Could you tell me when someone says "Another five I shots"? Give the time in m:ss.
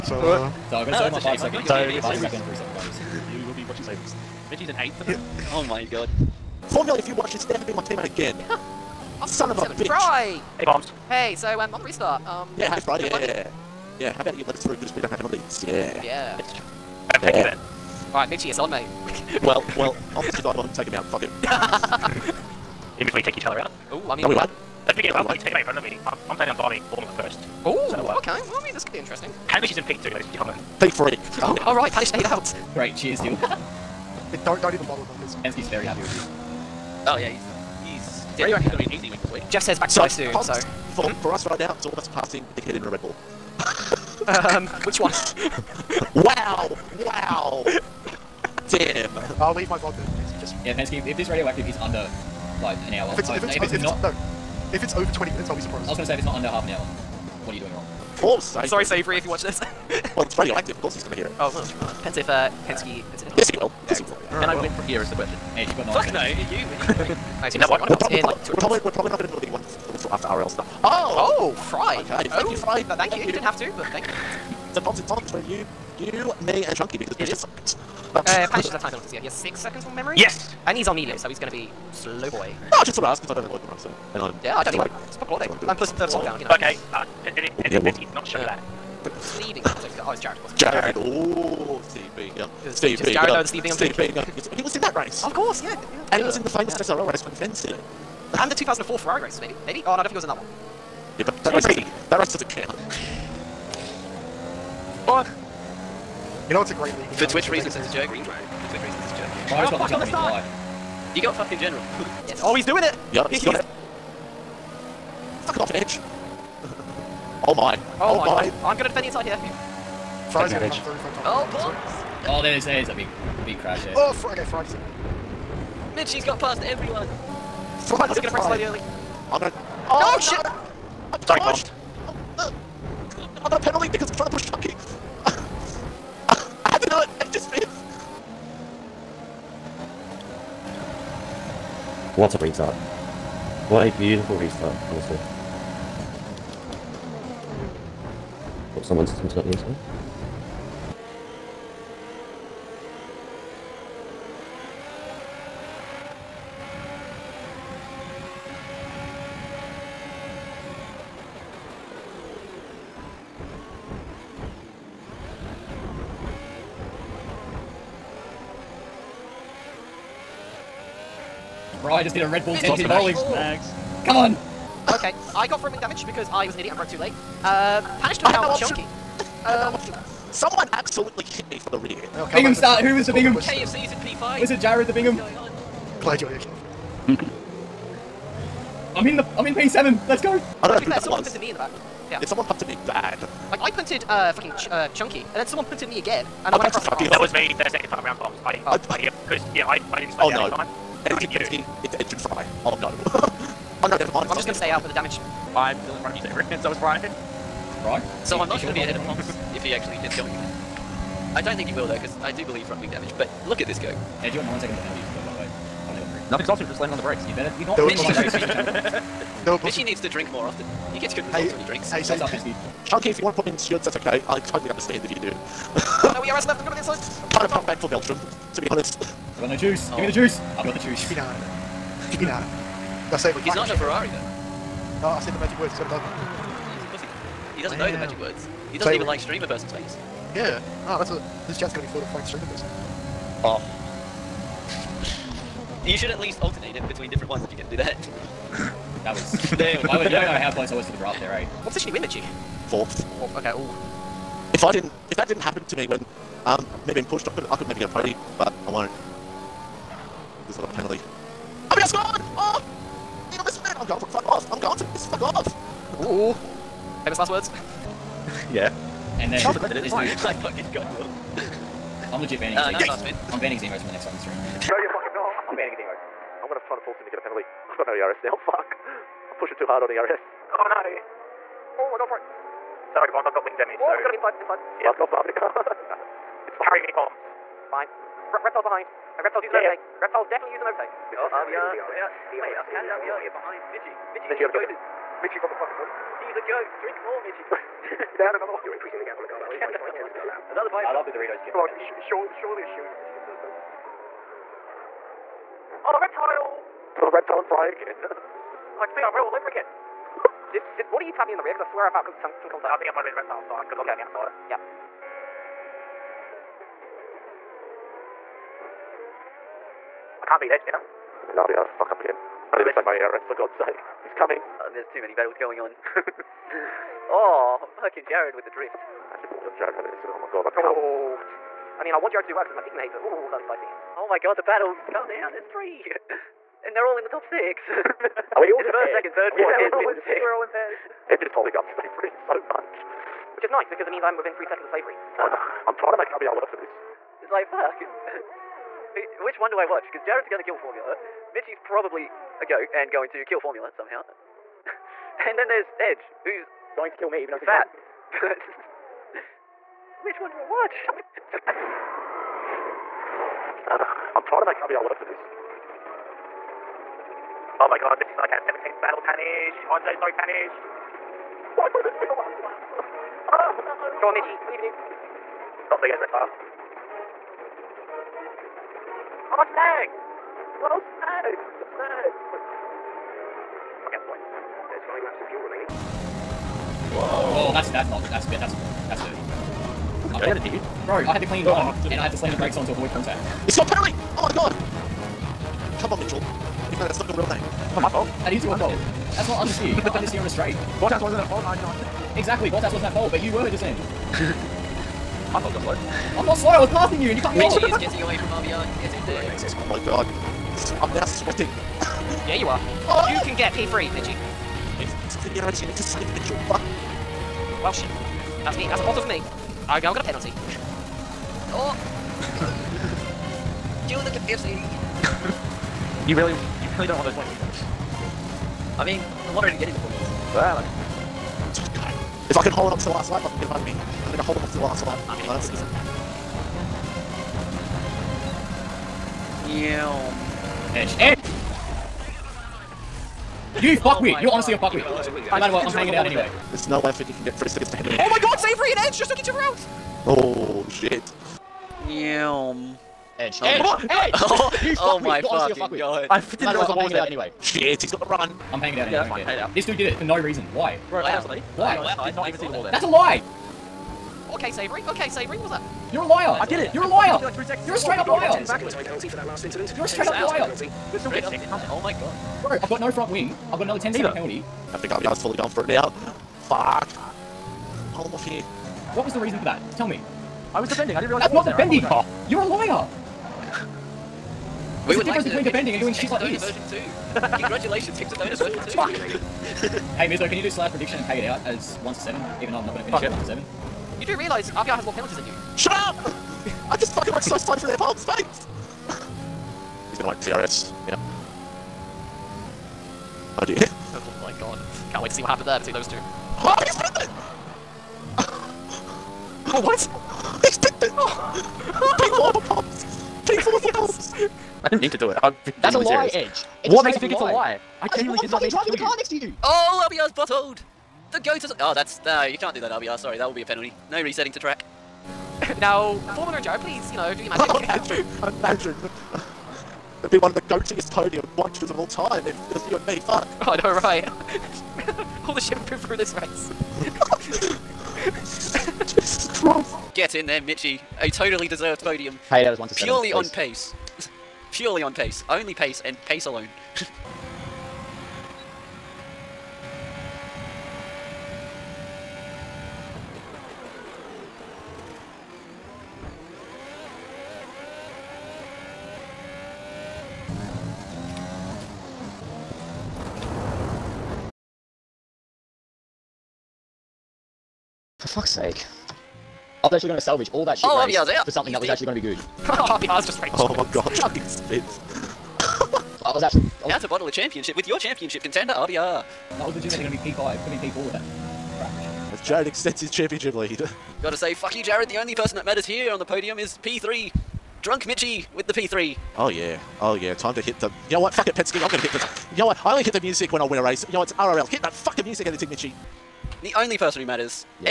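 5:00.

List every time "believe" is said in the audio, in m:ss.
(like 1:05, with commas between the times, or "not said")
3:32, 6:14.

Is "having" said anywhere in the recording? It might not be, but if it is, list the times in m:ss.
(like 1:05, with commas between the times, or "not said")
5:29.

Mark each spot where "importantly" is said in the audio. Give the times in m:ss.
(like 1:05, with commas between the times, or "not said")
not said.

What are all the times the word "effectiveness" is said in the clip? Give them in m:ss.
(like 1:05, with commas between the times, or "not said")
not said.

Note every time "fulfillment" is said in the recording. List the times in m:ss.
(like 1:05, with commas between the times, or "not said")
not said.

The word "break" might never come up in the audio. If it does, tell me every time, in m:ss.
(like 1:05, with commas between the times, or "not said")
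2:08.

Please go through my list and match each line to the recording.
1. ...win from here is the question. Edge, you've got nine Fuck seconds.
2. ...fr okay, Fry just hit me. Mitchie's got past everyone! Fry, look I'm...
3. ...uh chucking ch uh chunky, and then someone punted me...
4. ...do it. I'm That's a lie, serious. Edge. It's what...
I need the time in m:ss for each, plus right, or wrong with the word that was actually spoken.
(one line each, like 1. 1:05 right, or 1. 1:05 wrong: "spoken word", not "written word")
1. 1:04 right
2. 2:04 right
3. 3:14 wrong: "fucking", not "chucking"
4. 8:34 right.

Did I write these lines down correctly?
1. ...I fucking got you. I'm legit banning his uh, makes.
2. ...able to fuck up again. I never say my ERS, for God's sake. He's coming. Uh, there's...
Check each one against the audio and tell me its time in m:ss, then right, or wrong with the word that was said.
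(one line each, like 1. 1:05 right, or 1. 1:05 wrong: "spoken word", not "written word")
1. 4:30 wrong: "emotes", not "makes"
2. 5:21 right.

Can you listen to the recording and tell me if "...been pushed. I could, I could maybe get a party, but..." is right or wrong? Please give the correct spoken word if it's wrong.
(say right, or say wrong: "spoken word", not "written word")
right.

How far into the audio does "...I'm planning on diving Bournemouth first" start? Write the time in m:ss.
0:26.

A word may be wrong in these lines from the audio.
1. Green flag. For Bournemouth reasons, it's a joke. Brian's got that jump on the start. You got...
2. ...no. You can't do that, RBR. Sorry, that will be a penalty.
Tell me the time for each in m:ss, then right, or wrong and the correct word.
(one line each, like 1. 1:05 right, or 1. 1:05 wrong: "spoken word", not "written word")
1. 1:48 wrong: "Twitch", not "Bournemouth"
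2. 8:42 right.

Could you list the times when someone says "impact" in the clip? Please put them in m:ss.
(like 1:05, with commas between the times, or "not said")
not said.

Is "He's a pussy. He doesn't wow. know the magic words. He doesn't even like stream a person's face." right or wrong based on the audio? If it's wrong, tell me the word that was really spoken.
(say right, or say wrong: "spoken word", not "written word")
right.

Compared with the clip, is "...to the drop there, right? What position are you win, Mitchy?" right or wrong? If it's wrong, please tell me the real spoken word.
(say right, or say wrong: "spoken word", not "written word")
right.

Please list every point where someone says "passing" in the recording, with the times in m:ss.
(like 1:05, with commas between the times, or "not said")
0:42, 6:46.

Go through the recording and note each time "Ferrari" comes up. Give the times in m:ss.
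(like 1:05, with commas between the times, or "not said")
1:38, 3:53.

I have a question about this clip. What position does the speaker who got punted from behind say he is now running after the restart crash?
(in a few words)
P7.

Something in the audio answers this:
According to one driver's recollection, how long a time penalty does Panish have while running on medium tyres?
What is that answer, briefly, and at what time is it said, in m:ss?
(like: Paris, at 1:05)
6 seconds, at 1:19.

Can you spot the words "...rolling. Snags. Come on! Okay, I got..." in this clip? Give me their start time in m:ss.
2:52.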